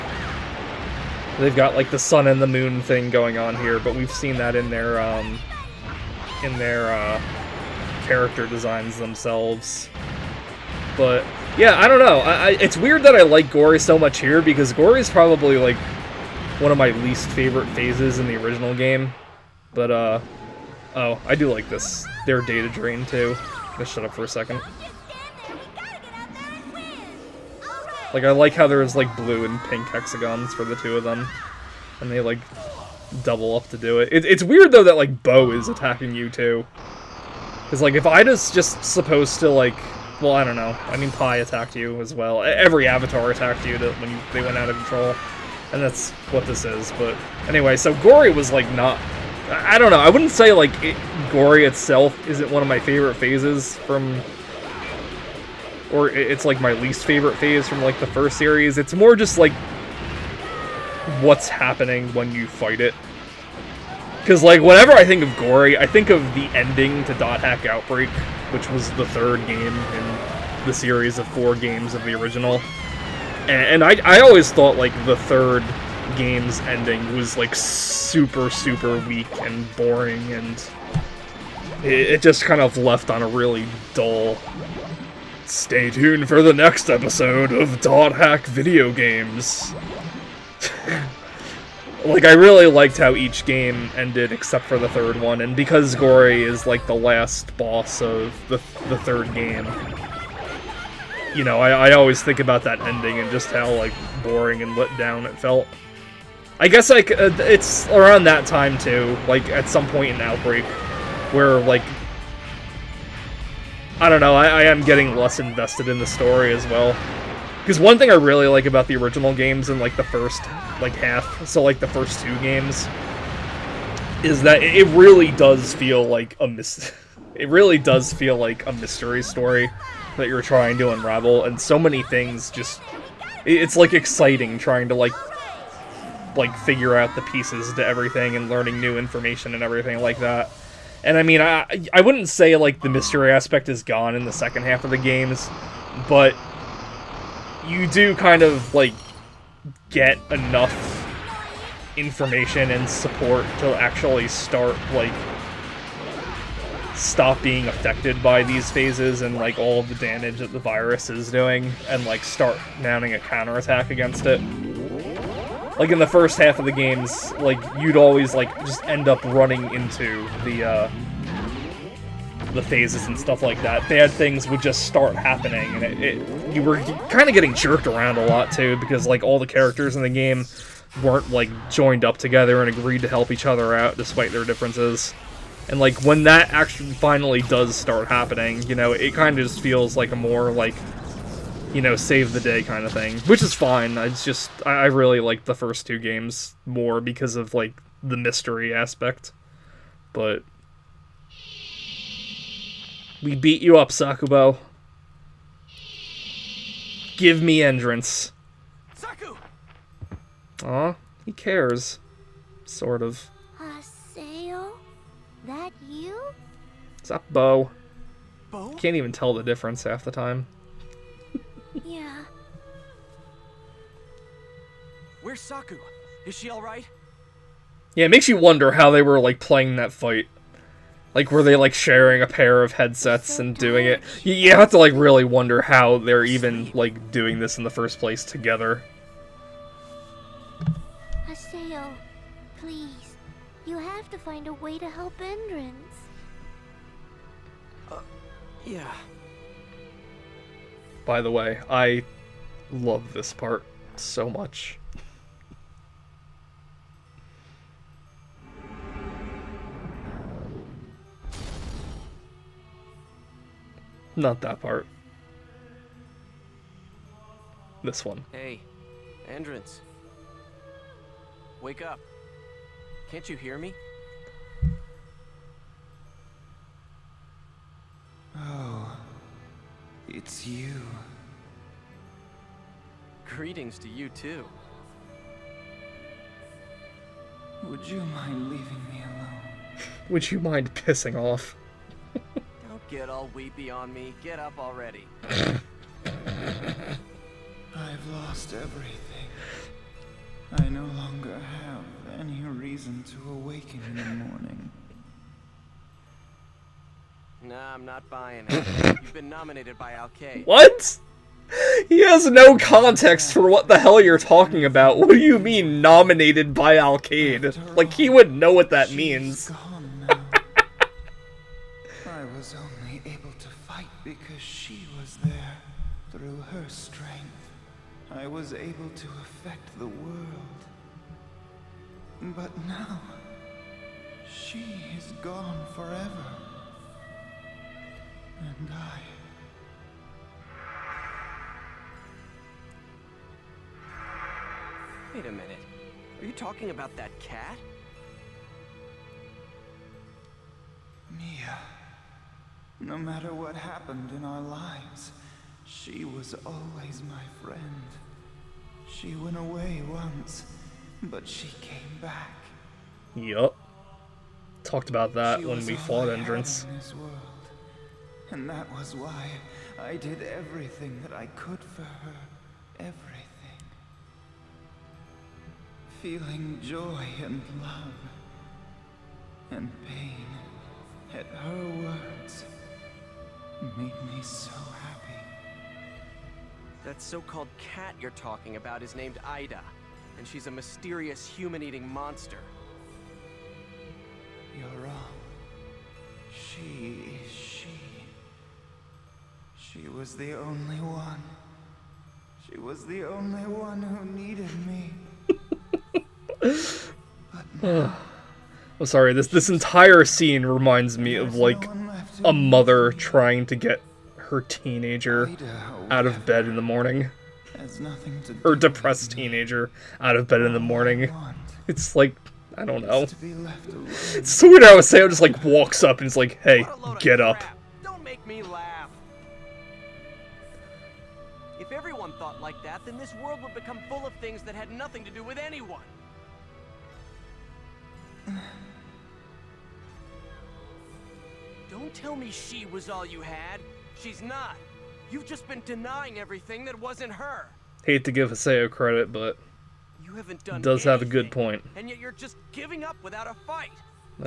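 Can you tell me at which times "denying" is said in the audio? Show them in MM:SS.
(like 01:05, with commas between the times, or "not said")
07:25.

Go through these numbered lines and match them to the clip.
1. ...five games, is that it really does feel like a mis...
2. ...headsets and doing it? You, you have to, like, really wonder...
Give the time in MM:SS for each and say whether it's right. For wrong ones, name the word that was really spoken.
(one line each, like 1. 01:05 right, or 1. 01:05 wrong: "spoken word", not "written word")
1. 02:02 wrong: "two", not "five"
2. 03:52 right.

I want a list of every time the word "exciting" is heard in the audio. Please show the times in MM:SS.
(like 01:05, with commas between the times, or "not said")
02:13.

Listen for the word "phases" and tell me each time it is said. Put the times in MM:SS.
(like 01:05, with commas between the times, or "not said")
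00:17, 00:53, 00:57, 02:38, 02:52.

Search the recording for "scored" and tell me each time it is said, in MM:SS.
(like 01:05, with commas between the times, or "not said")
not said.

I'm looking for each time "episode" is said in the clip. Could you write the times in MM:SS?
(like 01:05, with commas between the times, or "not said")
01:26.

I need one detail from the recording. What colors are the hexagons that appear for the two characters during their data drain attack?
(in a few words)
Blue and pink.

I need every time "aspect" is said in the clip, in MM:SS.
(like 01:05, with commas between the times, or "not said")
02:23, 03:18.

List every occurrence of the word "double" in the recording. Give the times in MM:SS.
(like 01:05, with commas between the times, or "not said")
00:33.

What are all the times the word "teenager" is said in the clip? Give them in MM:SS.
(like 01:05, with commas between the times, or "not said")
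06:54, 06:59.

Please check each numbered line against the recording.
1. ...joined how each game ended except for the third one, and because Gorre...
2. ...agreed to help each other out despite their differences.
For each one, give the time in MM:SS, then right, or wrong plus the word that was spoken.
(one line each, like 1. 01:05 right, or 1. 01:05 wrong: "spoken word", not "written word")
1. 01:32 wrong: "liked", not "joined"
2. 03:02 right.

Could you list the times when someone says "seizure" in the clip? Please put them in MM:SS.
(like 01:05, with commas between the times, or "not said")
not said.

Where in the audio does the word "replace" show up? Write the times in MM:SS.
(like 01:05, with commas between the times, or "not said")
not said.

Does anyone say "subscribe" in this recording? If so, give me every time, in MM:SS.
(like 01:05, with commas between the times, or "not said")
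not said.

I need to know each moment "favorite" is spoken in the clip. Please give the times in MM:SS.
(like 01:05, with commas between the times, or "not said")
00:17, 00:52, 00:57.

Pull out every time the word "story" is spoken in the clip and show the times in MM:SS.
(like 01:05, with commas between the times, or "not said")
01:56, 02:09.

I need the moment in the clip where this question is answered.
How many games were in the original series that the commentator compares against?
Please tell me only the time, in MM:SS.
01:11.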